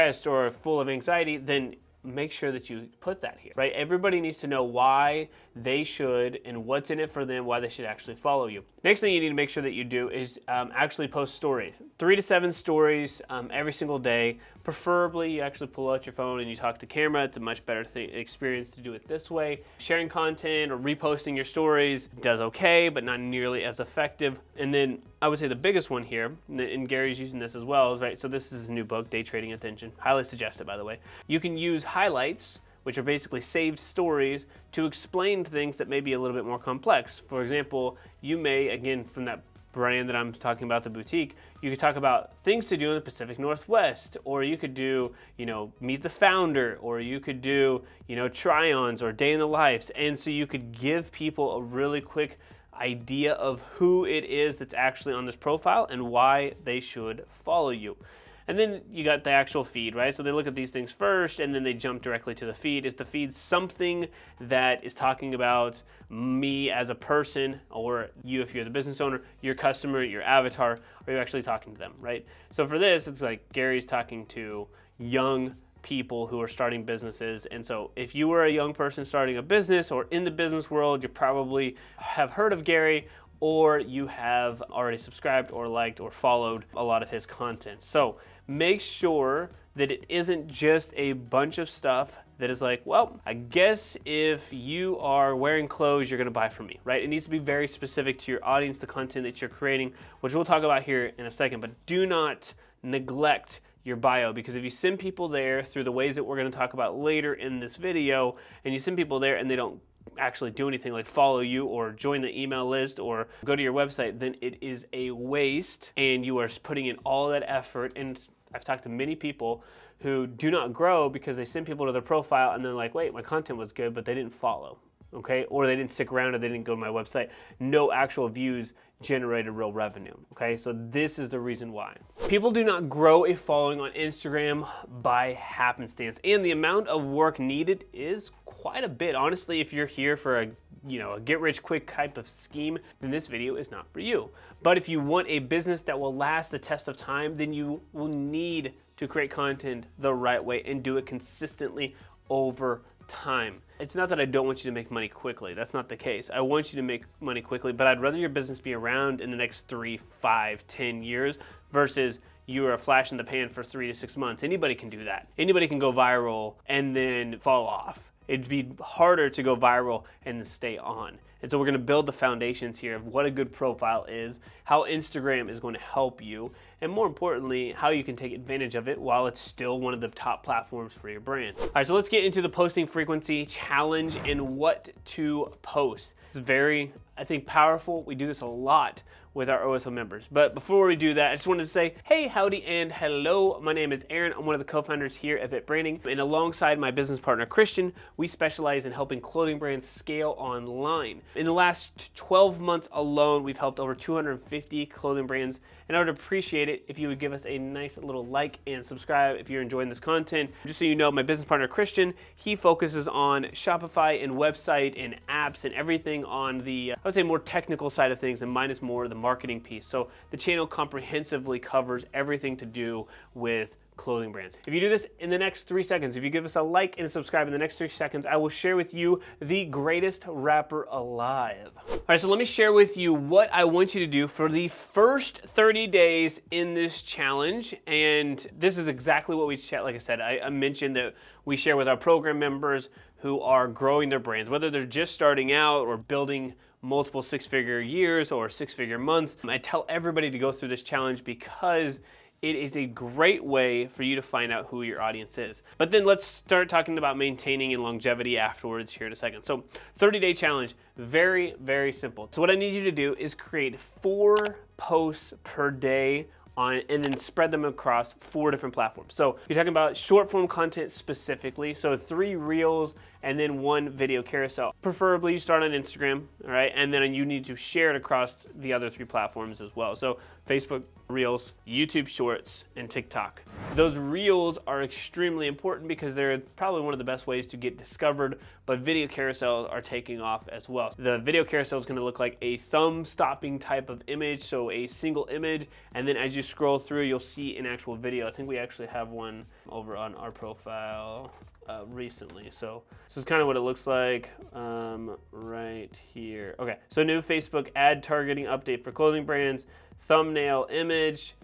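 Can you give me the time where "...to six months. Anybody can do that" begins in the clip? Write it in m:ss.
2:43.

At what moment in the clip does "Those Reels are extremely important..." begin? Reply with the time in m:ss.
4:43.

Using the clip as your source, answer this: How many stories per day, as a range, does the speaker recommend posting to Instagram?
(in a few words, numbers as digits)
3 to 7.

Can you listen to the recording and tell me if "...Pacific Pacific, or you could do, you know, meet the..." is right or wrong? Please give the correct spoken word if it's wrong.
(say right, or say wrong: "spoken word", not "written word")
wrong: "Northwest", not "Pacific".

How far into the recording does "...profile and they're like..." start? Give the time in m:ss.
2:02.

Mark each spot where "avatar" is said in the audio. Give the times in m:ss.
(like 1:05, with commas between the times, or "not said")
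1:10.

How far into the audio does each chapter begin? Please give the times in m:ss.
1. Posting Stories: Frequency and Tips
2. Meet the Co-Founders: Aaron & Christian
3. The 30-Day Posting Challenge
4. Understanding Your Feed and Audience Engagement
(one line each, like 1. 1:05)
1. 0:19
2. 3:26
3. 4:09
4. 1:58.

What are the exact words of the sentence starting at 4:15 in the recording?
But then let's start talking about maintaining and longevity afterwards here in a second.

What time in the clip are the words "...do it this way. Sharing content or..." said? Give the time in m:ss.
0:18.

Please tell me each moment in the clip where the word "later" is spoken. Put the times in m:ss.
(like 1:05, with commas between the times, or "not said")
1:46.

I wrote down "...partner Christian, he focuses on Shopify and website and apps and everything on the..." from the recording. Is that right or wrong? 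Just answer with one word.
right.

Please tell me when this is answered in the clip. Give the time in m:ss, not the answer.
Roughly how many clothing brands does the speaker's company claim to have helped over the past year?
3:23.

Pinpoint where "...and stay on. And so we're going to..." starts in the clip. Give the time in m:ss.
2:50.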